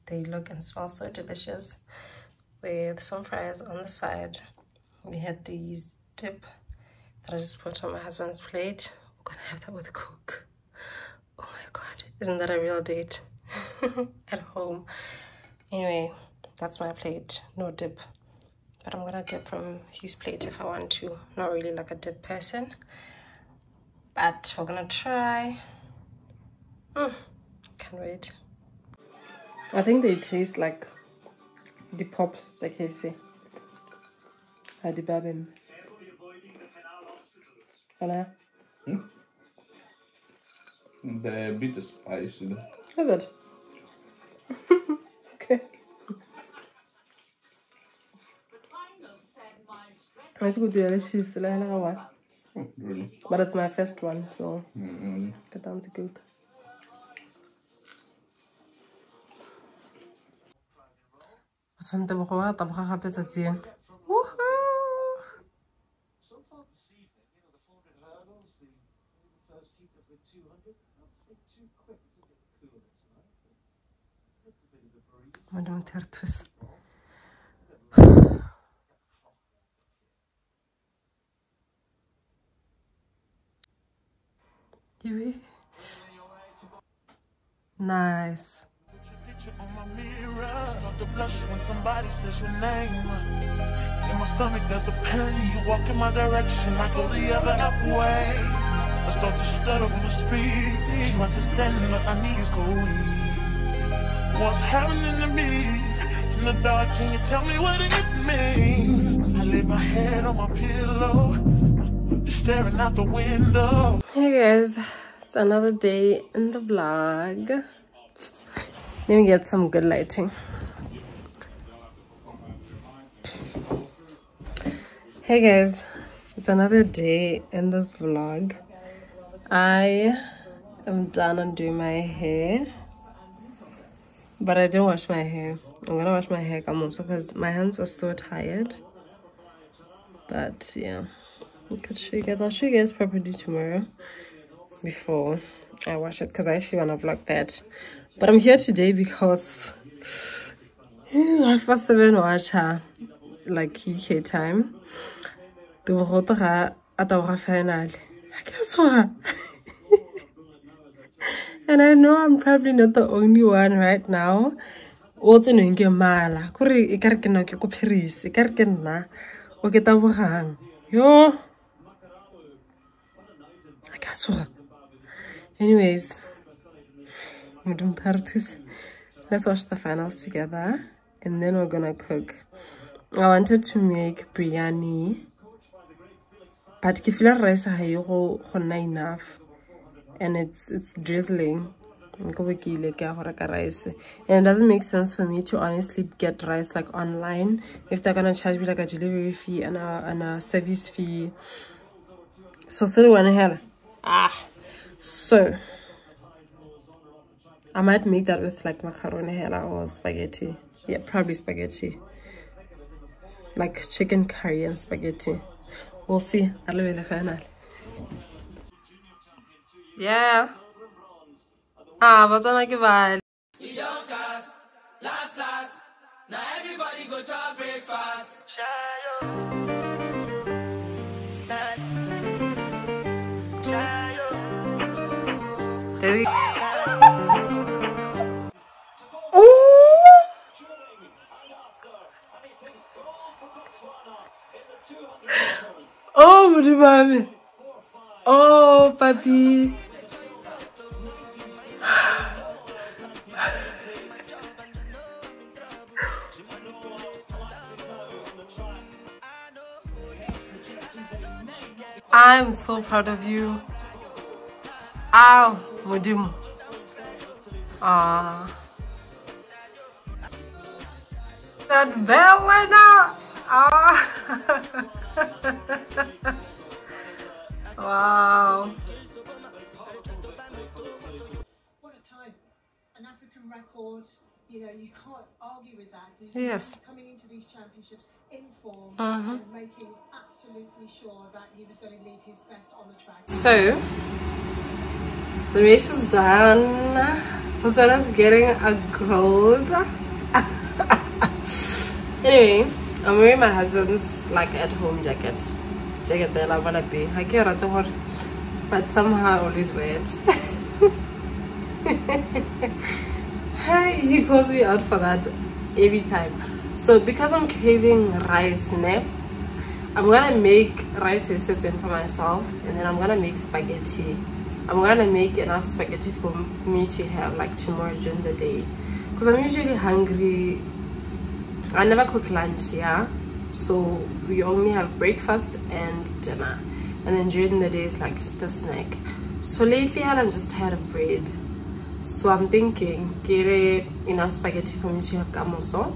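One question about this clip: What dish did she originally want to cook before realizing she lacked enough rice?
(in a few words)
biryani.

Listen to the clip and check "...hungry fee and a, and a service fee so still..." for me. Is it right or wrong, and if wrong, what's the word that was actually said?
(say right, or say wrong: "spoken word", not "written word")
wrong: "delivery", not "hungry".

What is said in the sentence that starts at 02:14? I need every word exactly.
But I didn't wash my hair.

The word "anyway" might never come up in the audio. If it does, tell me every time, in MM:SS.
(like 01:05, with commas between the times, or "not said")
00:15, 02:55, 05:02.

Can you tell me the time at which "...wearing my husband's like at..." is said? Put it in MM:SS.
05:03.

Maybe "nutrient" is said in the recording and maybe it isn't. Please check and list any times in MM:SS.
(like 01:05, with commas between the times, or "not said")
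not said.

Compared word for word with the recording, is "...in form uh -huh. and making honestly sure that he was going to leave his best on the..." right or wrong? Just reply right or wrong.
wrong.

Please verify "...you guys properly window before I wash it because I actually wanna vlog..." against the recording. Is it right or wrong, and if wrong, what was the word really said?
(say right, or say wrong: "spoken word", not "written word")
wrong: "tomorrow", not "window".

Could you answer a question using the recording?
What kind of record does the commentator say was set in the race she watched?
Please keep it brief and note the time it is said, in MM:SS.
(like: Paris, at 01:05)
An African record, at 04:42.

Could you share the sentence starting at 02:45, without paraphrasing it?
What's in your mala kore e ka re ke nna ke ko paris e ka re ke yo I guess what?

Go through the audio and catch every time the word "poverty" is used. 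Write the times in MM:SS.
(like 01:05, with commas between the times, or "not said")
not said.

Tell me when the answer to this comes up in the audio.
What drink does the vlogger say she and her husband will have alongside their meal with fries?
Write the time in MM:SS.
00:09.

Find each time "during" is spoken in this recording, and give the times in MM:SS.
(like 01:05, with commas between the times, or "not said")
05:27, 05:37.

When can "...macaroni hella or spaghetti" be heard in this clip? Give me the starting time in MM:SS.
03:28.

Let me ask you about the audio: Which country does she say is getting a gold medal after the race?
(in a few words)
Botswana.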